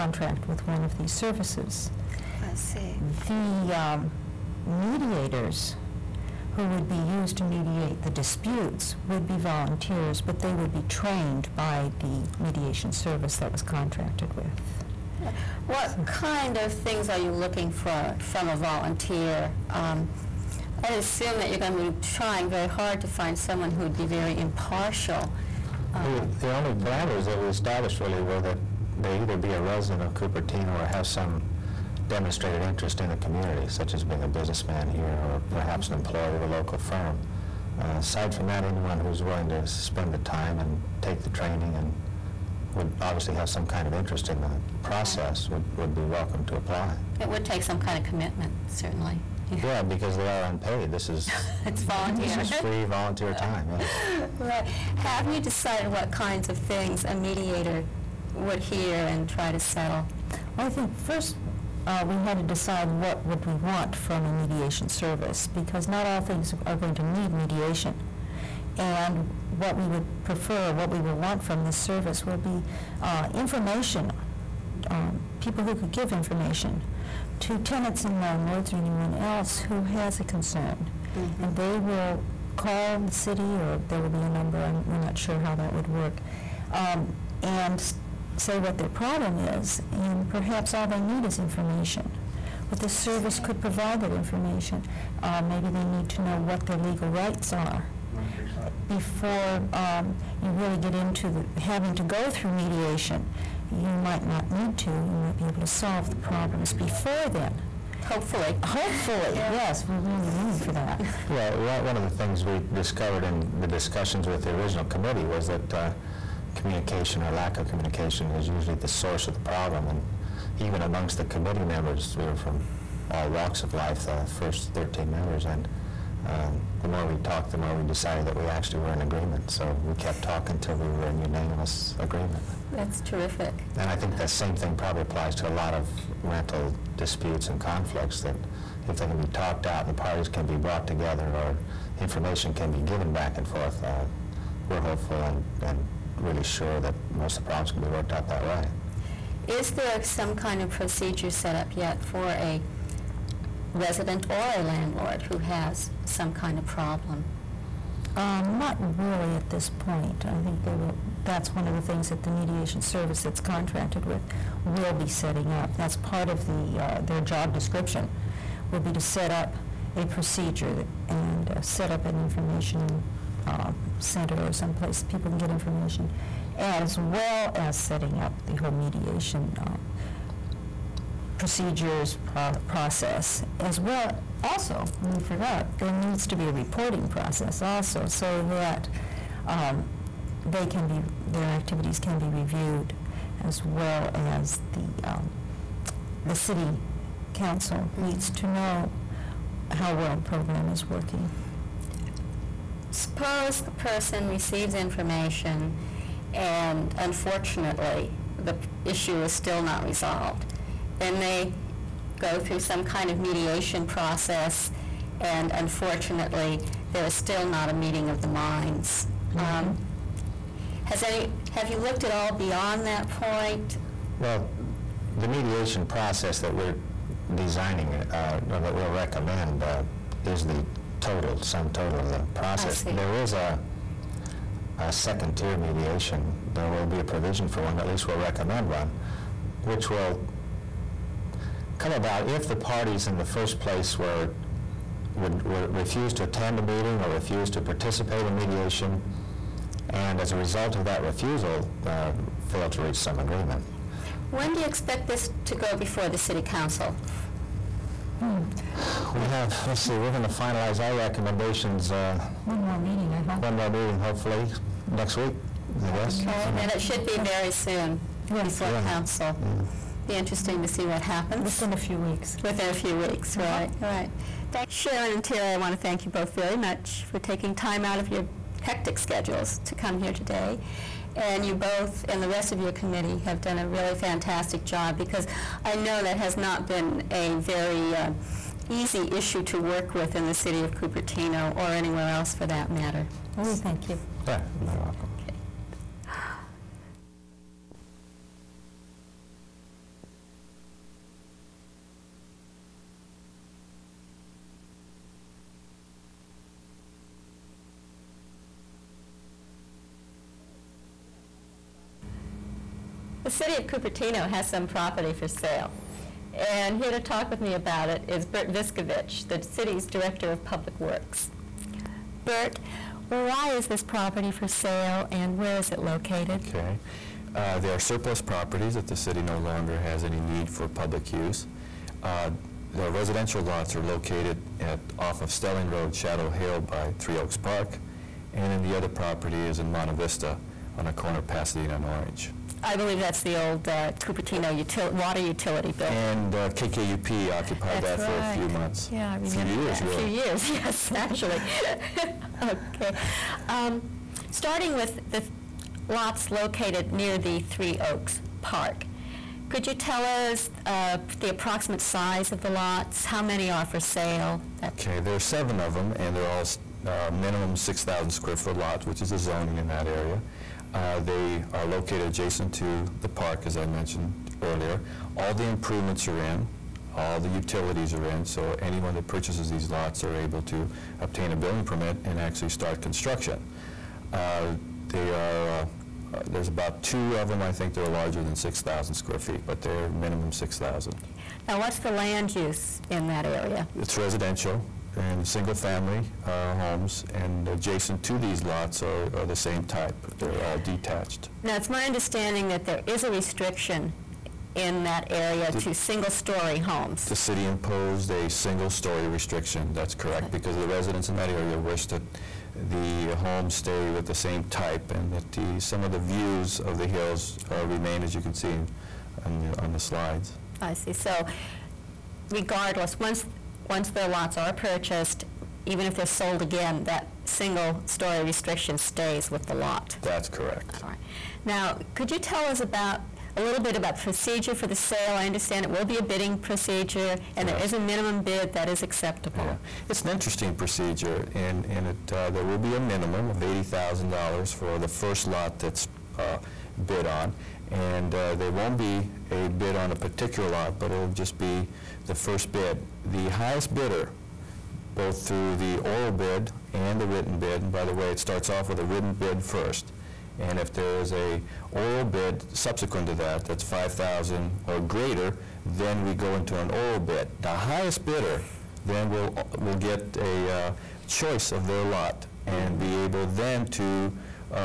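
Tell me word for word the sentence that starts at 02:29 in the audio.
Is there some kind of procedure set up yet for a resident or a landlord who has some kind of problem?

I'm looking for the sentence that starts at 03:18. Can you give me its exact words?
needs to know how well the program is working.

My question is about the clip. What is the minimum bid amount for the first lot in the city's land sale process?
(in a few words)
$80,000.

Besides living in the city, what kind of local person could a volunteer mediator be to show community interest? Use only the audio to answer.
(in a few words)
businessman.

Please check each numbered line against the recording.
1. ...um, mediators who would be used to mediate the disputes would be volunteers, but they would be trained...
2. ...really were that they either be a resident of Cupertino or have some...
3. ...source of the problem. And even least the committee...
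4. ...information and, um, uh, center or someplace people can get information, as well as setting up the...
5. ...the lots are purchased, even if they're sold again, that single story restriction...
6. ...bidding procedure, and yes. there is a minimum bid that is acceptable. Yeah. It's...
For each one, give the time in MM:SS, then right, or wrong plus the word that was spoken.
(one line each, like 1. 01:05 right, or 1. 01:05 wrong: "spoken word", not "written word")
1. 00:03 right
2. 00:28 right
3. 01:58 wrong: "amongst", not "least"
4. 02:52 right
5. 07:03 right
6. 07:16 right.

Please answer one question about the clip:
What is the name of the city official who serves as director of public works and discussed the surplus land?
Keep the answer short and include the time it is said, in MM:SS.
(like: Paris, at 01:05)
Bert Viskovich, at 05:18.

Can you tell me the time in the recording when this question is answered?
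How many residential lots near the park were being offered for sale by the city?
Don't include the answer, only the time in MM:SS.
06:05.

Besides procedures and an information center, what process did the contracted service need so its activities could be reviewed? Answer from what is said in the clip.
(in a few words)
reporting process.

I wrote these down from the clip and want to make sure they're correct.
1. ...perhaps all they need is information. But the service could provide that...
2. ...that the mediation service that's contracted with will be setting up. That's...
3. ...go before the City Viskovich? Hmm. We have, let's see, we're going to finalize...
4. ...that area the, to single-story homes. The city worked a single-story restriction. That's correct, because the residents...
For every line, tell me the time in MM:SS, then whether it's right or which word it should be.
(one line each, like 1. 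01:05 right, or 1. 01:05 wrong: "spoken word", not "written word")
1. 01:30 right
2. 02:42 right
3. 04:15 wrong: "Council", not "Viskovich"
4. 06:44 wrong: "imposed", not "worked".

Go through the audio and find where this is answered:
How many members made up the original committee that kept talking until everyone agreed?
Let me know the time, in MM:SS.
02:04.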